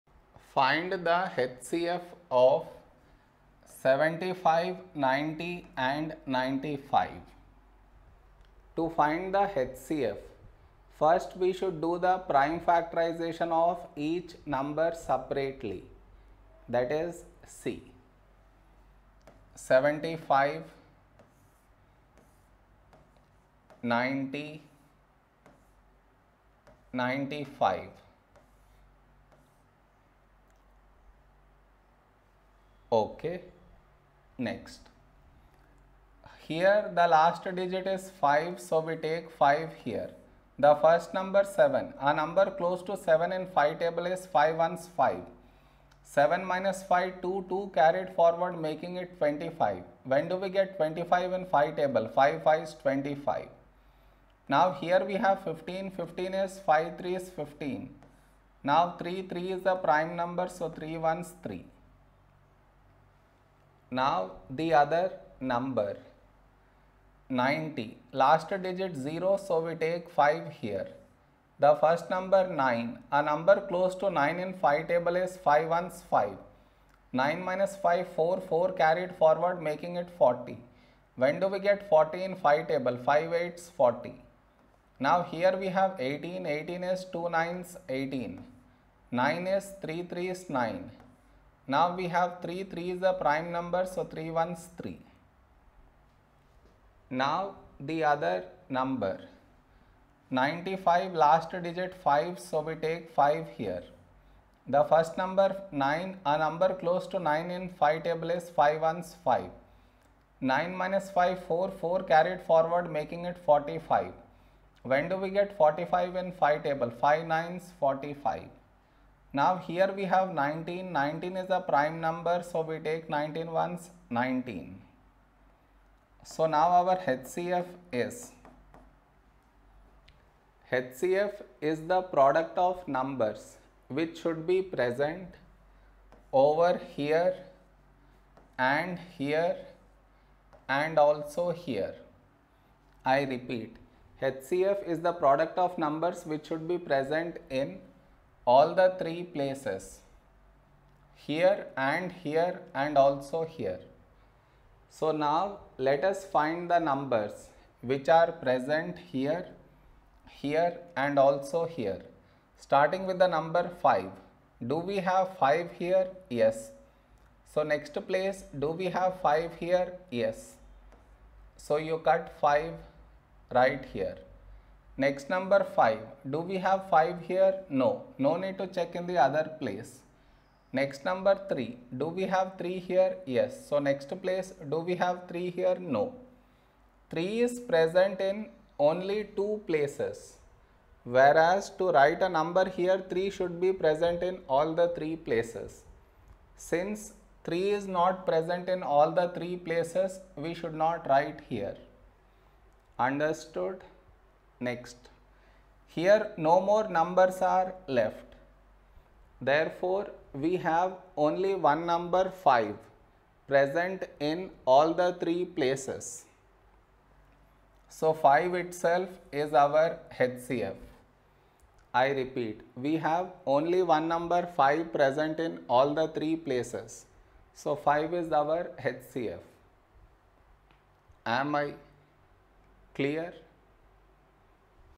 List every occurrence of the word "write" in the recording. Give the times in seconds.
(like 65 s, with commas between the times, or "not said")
191 s, 201 s.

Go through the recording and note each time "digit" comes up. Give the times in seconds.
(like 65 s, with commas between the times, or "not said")
37 s, 68 s, 101 s.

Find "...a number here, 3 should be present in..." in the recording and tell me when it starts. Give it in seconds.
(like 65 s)
192 s.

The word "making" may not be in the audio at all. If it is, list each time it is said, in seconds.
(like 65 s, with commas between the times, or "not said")
48 s, 79 s, 112 s.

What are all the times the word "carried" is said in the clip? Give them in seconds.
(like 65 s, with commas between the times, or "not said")
47 s, 78 s, 112 s.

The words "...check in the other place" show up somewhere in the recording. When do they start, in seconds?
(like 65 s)
178 s.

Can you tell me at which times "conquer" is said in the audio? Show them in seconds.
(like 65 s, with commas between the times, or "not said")
not said.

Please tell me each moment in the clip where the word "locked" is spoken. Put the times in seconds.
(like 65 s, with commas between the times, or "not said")
not said.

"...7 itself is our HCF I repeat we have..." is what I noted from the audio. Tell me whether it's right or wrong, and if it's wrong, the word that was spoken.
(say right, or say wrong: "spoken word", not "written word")
wrong: "5", not "7".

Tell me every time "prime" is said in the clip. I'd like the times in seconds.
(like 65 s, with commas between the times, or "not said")
12 s, 59 s, 93 s, 121 s.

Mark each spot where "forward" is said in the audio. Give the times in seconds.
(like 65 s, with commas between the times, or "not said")
48 s, 79 s, 112 s.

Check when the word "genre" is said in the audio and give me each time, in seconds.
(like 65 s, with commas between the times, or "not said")
not said.